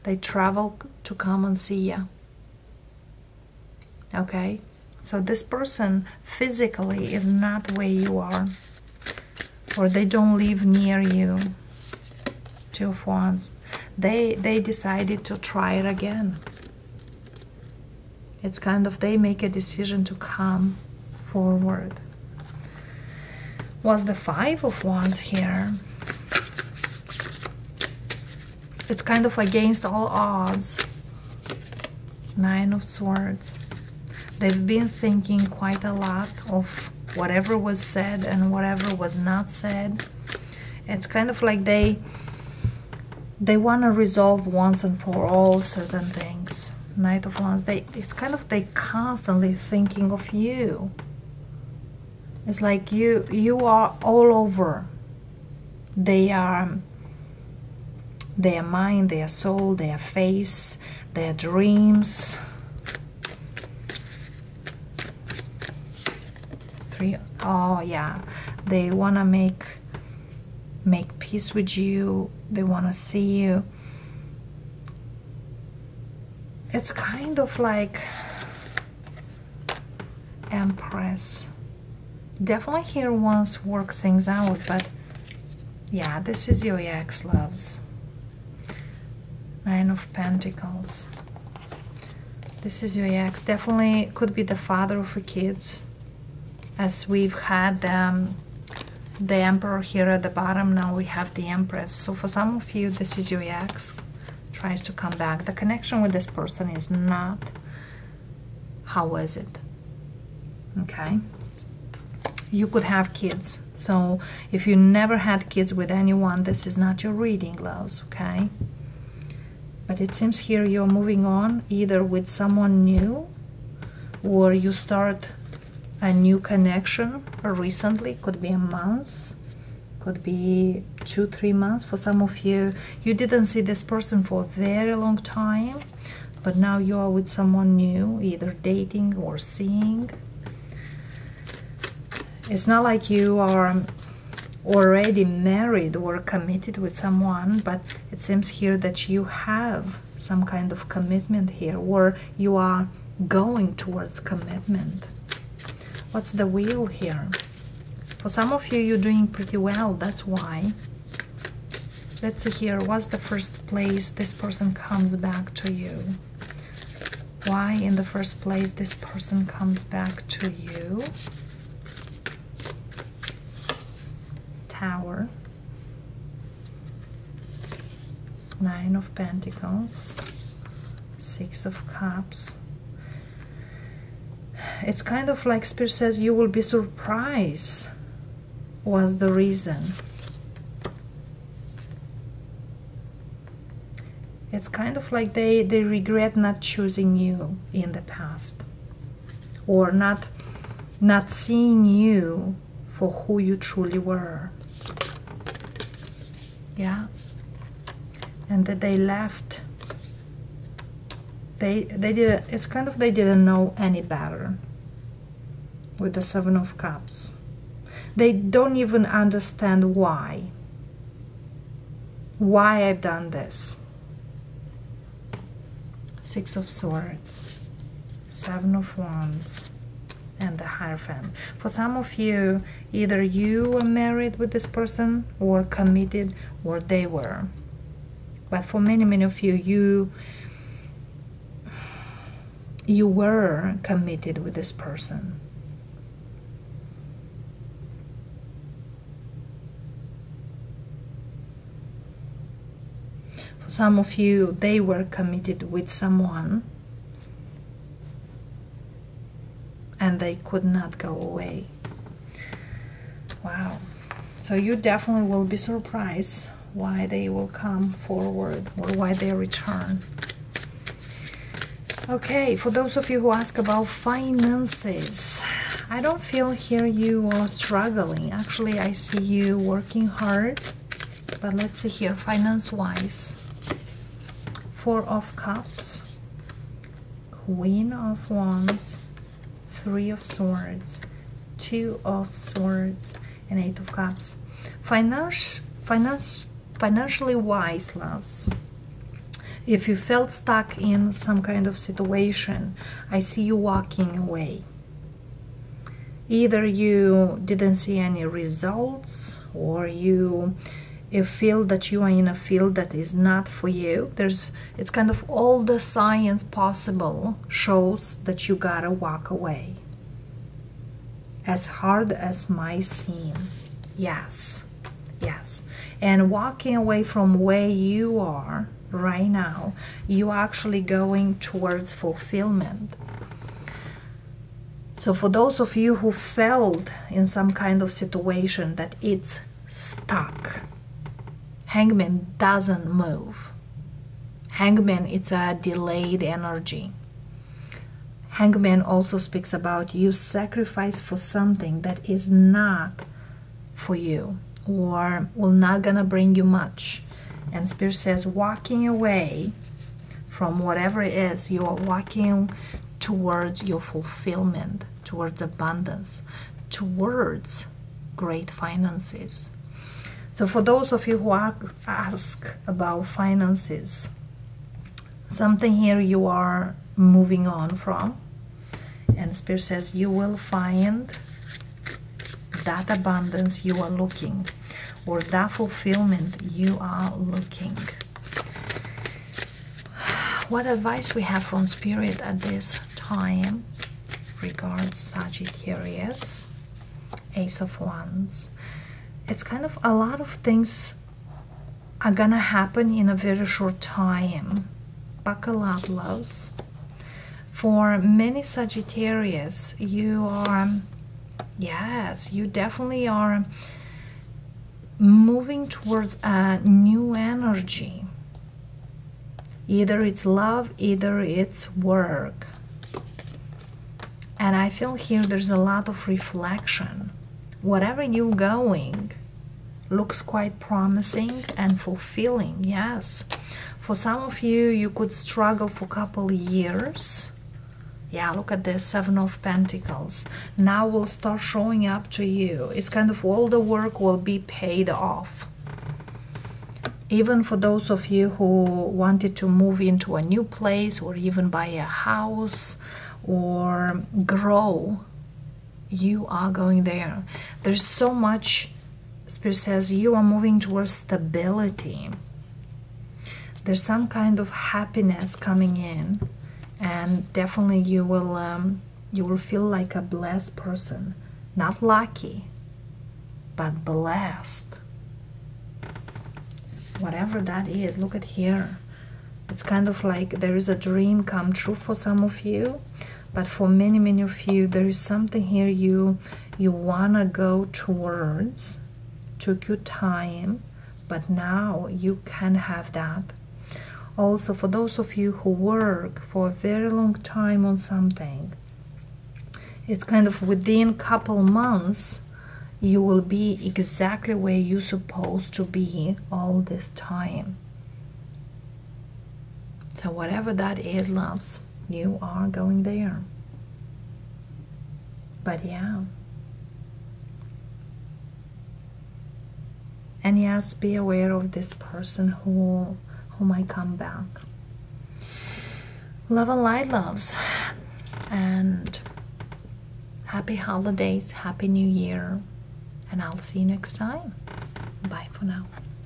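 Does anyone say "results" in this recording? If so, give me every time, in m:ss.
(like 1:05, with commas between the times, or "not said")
5:08.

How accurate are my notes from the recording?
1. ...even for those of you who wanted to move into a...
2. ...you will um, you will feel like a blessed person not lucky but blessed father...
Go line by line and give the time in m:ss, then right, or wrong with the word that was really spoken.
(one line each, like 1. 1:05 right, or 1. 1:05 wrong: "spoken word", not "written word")
1. 7:27 right
2. 7:47 wrong: "whatever", not "father".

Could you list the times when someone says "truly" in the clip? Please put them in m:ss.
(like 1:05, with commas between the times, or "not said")
3:23.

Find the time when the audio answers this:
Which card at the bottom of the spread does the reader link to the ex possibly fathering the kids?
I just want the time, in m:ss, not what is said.
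1:39.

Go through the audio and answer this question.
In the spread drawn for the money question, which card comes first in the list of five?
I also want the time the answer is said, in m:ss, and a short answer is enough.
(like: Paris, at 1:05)
Four of Cups, at 4:44.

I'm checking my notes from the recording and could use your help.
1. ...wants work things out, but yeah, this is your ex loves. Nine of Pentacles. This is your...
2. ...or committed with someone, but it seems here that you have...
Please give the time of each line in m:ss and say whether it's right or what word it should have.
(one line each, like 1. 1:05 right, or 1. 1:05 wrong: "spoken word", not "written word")
1. 1:23 right
2. 2:25 right.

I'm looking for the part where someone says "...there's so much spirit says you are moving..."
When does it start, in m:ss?
7:37.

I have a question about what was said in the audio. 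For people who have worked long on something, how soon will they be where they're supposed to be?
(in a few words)
Couple months.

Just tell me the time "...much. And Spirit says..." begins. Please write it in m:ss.
5:56.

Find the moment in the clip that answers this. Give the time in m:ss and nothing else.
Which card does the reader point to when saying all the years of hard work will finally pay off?
7:18.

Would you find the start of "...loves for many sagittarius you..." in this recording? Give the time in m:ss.
6:45.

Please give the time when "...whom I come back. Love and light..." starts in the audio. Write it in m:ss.
8:43.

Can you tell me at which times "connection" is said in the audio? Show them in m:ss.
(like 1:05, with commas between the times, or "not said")
1:45, 2:06.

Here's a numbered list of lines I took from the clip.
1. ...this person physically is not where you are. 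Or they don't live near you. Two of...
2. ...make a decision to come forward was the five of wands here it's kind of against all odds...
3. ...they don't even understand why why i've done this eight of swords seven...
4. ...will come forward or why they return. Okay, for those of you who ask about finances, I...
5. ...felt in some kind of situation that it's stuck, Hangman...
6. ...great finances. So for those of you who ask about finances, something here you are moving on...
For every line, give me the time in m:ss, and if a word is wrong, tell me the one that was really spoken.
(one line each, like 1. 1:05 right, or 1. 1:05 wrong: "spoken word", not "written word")
1. 0:05 right
2. 0:19 right
3. 3:38 wrong: "six", not "eight"
4. 4:27 right
5. 5:36 right
6. 6:08 right.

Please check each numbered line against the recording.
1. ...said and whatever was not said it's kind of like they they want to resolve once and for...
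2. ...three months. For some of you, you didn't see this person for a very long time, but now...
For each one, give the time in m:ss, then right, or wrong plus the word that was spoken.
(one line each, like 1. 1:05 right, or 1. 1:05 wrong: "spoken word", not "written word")
1. 0:37 right
2. 2:11 right.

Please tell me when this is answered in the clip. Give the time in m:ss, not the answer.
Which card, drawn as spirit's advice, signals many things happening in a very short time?
6:37.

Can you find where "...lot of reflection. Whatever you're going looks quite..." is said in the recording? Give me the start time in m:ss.
7:05.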